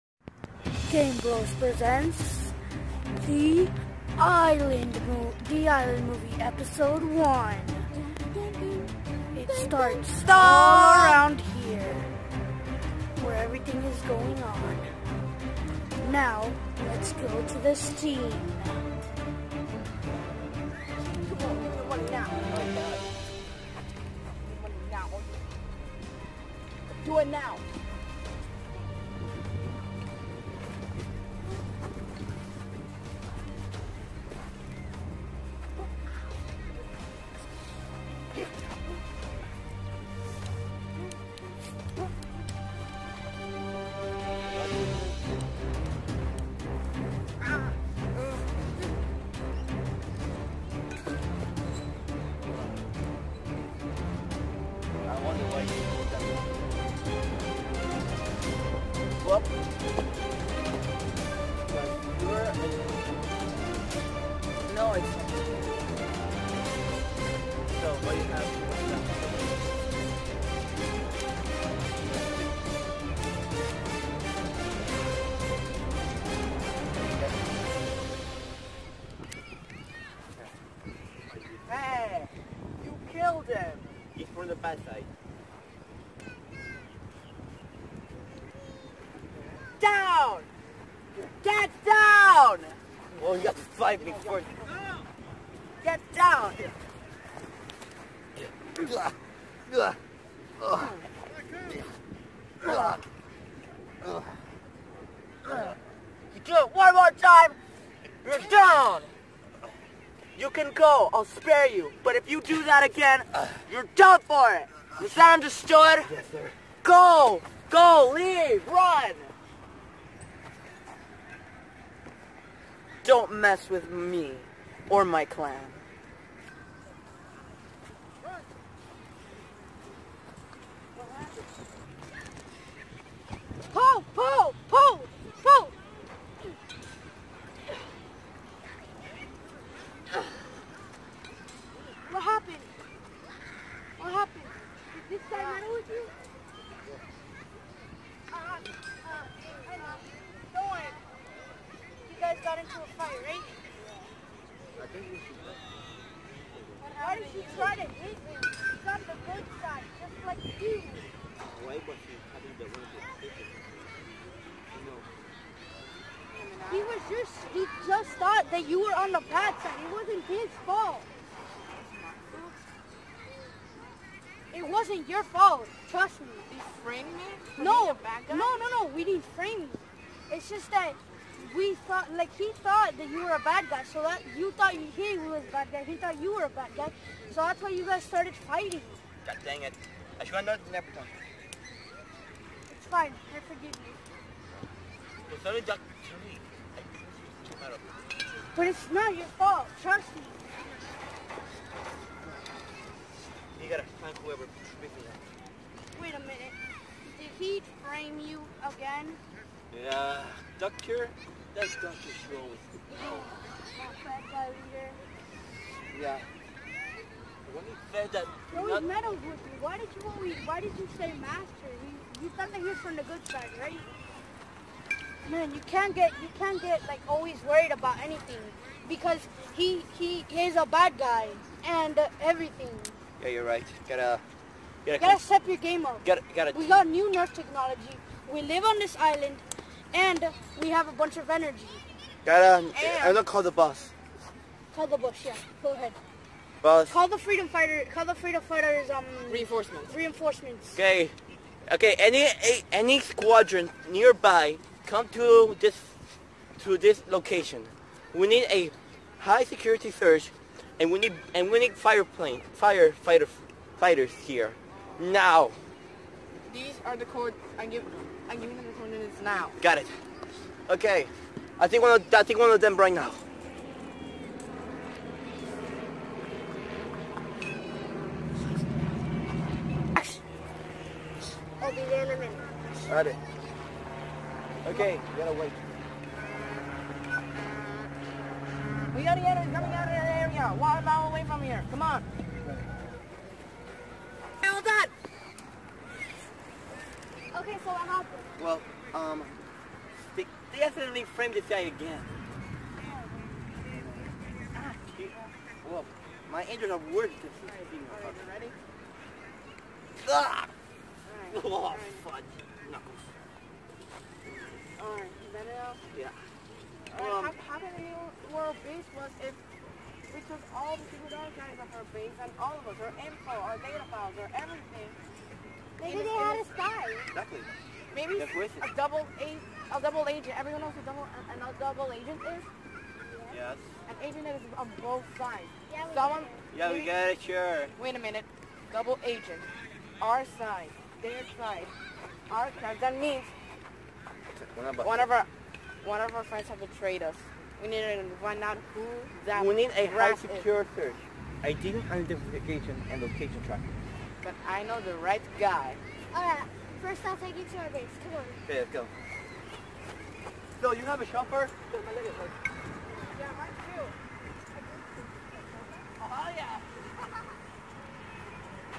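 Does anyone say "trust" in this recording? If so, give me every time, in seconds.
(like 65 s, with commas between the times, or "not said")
175 s, 199 s.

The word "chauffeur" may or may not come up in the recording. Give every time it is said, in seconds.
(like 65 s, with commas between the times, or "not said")
361 s.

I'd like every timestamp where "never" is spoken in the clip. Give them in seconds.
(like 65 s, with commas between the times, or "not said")
190 s.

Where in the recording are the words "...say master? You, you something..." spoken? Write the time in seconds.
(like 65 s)
220 s.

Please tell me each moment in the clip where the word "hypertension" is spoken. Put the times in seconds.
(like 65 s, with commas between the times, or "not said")
not said.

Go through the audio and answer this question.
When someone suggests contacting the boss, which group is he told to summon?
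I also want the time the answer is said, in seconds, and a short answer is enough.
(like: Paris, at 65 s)
The freedom fighters, at 248 s.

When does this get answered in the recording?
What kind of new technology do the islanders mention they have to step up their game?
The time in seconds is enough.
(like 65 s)
237 s.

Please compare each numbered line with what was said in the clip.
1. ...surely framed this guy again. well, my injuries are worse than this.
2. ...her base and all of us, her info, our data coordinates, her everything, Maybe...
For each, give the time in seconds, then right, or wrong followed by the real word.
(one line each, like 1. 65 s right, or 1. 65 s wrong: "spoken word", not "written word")
1. 300 s wrong: "accidentally", not "surely"
2. 321 s wrong: "files", not "coordinates".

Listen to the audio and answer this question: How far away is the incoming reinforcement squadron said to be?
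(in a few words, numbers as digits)
One mile.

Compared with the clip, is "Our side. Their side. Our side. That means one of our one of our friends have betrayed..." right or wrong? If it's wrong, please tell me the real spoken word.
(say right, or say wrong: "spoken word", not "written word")
right.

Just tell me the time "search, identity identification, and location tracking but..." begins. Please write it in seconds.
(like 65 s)
350 s.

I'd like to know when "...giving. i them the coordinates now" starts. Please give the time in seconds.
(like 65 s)
267 s.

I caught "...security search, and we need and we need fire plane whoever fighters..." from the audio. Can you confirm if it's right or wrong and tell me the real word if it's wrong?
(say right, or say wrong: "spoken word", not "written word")
wrong: "firefighter", not "whoever".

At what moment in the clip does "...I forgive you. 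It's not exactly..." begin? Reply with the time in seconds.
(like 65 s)
193 s.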